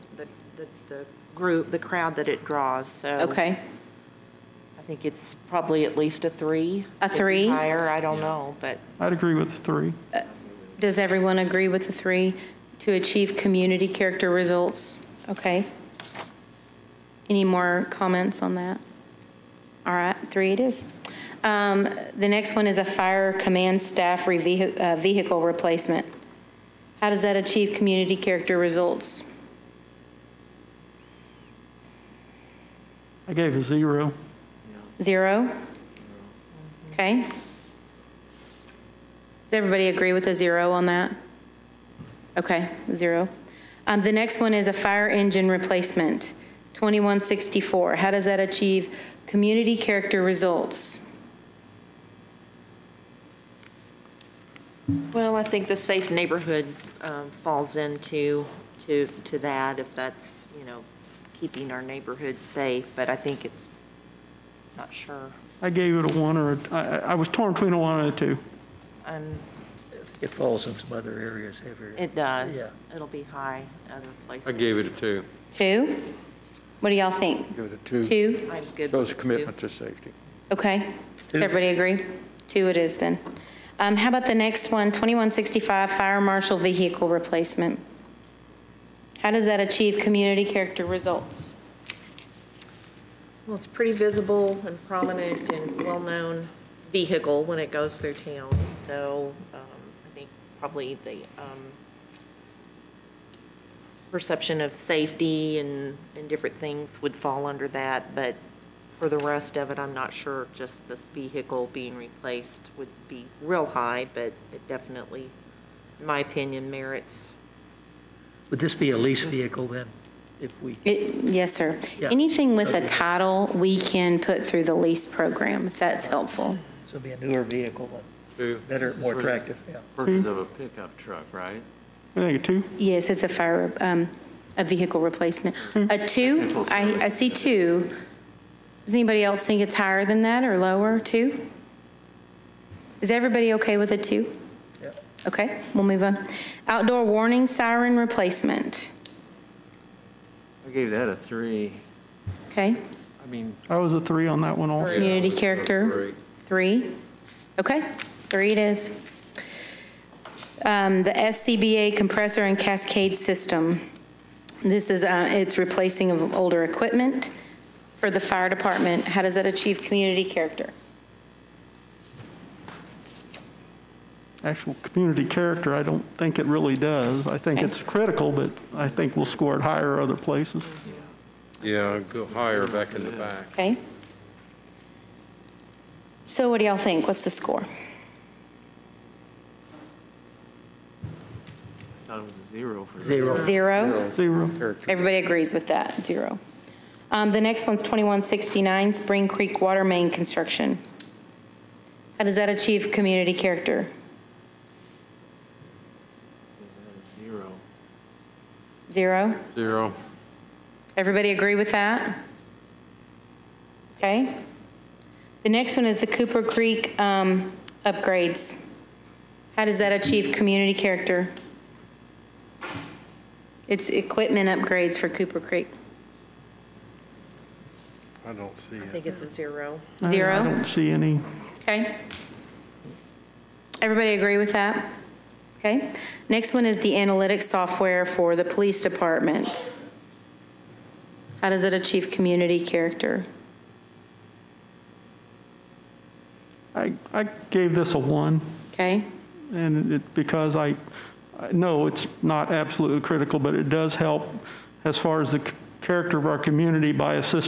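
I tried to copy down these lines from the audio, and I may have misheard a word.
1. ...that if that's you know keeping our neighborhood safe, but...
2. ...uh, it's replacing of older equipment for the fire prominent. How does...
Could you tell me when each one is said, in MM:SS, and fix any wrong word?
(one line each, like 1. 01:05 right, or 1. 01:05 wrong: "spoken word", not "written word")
1. 00:59 right
2. 02:45 wrong: "department", not "prominent".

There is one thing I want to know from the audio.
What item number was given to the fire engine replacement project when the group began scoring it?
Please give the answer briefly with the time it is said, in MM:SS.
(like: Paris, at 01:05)
2164, at 00:46.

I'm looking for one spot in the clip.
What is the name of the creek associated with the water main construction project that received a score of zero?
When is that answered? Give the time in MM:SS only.
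03:18.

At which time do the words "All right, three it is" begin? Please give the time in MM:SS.
00:19.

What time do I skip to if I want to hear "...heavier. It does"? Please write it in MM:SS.
01:11.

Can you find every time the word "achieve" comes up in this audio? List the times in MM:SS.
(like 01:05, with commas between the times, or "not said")
00:12, 00:27, 00:48, 01:29, 02:49, 03:22, 03:39, 04:01.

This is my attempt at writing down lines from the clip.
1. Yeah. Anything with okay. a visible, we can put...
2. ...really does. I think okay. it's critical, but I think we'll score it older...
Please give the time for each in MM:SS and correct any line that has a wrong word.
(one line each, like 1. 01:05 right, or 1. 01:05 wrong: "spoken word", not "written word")
1. 02:01 wrong: "title", not "visible"
2. 02:56 wrong: "higher", not "older".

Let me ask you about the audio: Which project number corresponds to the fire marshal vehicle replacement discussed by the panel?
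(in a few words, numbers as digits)
2165.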